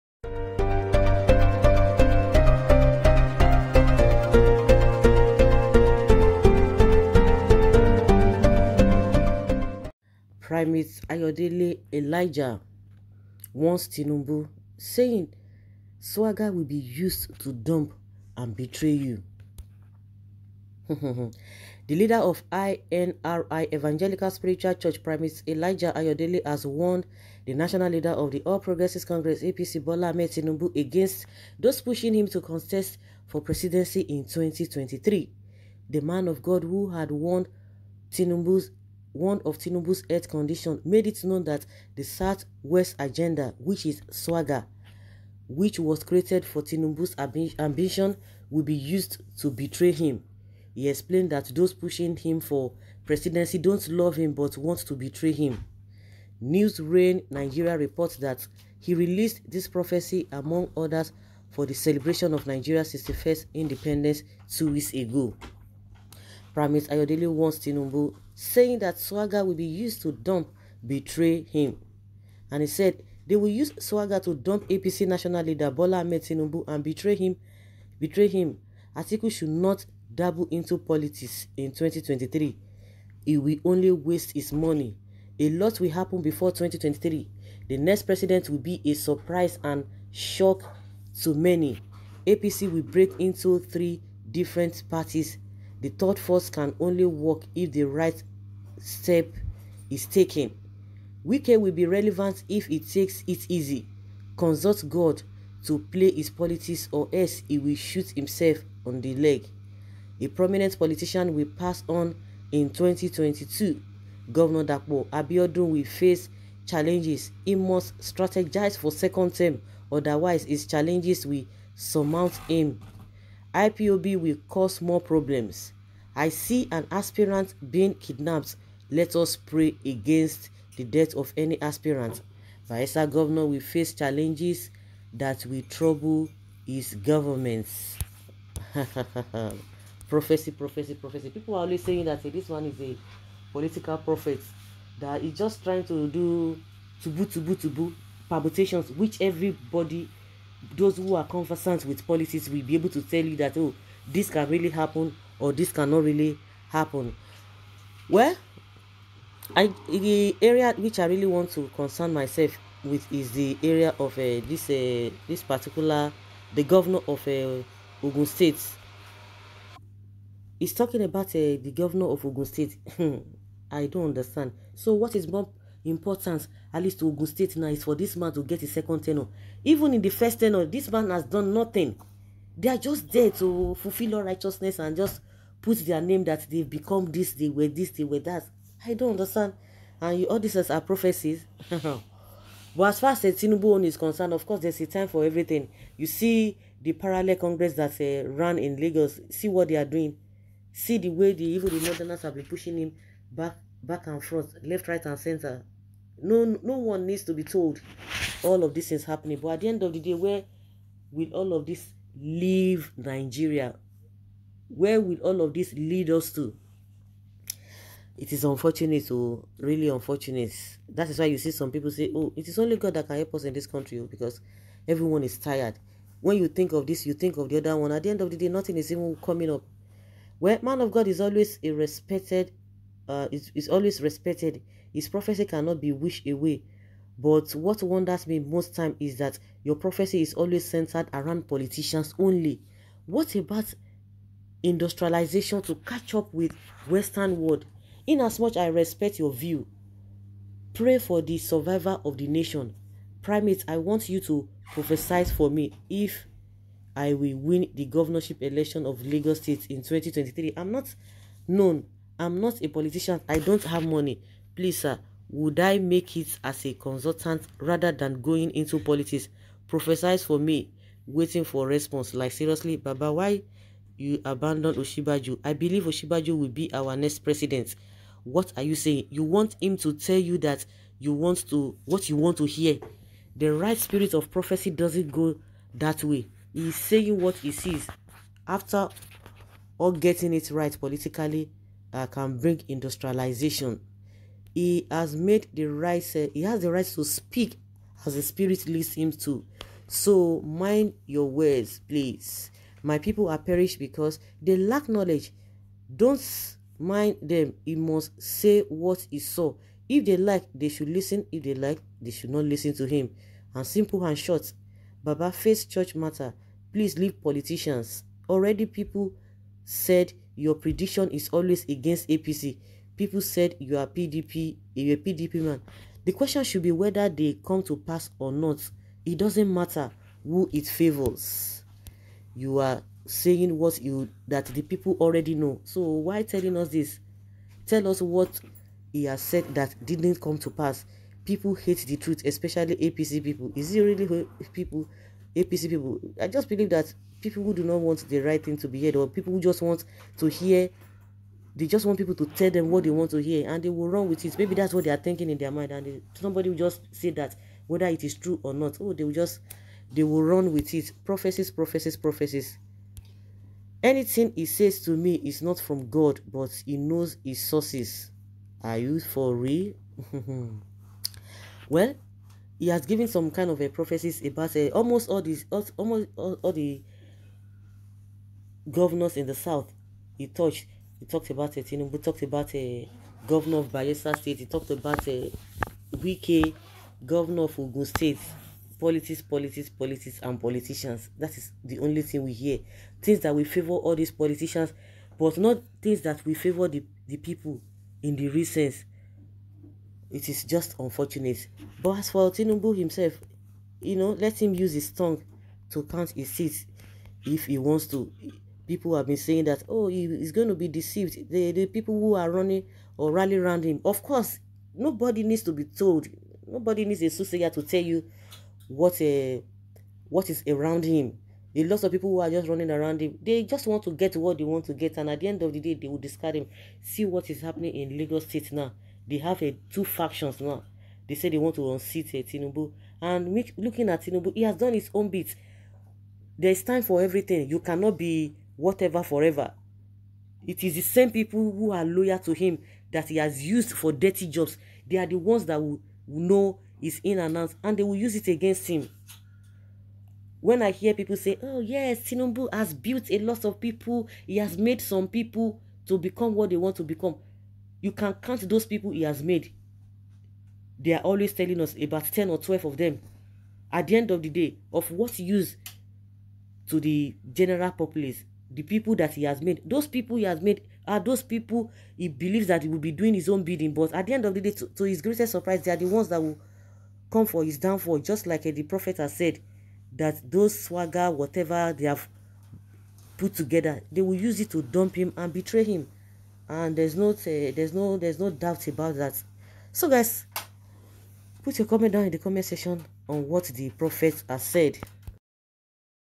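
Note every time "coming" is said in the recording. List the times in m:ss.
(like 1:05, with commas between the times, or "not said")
3:49.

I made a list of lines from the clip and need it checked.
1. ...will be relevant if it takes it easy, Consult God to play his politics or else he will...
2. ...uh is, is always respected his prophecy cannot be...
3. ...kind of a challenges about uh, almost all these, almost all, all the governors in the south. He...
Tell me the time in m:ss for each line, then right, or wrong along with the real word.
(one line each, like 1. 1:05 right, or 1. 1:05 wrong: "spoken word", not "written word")
1. 1:41 right
2. 3:53 right
3. 6:13 wrong: "prophecies", not "challenges".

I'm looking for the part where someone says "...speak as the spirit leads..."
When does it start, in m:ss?
4:57.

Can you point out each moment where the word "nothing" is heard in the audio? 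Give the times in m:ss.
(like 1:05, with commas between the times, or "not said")
3:01, 3:48.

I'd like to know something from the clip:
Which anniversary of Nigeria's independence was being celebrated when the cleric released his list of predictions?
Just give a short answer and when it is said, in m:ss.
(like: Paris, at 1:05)
61st, at 1:02.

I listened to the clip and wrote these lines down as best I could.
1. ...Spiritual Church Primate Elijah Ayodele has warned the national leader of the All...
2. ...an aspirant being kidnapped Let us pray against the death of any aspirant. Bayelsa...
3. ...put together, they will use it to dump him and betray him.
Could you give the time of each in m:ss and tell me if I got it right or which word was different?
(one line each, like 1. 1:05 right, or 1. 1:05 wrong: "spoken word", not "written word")
1. 0:24 right
2. 2:06 right
3. 8:03 right.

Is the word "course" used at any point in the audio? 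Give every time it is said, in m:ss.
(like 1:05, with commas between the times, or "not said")
3:14, 6:54.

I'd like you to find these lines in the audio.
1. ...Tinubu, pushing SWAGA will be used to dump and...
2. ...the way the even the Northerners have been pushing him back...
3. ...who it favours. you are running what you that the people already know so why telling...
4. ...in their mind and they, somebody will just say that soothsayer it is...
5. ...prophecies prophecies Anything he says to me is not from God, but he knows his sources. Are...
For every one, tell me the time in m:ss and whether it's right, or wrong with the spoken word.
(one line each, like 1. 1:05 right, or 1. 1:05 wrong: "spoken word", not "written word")
1. 0:13 wrong: "saying", not "pushing"
2. 3:20 right
3. 5:30 wrong: "saying", not "running"
4. 5:55 wrong: "whether", not "soothsayer"
5. 6:01 right.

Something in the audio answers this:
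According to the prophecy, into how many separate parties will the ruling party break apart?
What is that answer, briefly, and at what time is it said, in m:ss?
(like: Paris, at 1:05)
3, at 1:33.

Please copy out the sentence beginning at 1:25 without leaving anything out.
A lot will happen before 2023.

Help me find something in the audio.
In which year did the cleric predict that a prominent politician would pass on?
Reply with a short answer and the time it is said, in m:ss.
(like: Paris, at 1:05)
2022, at 1:52.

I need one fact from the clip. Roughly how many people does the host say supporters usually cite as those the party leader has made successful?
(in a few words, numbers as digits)
10 or 12.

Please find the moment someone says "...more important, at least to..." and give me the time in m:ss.
2:55.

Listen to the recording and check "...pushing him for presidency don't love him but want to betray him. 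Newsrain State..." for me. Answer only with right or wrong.
wrong.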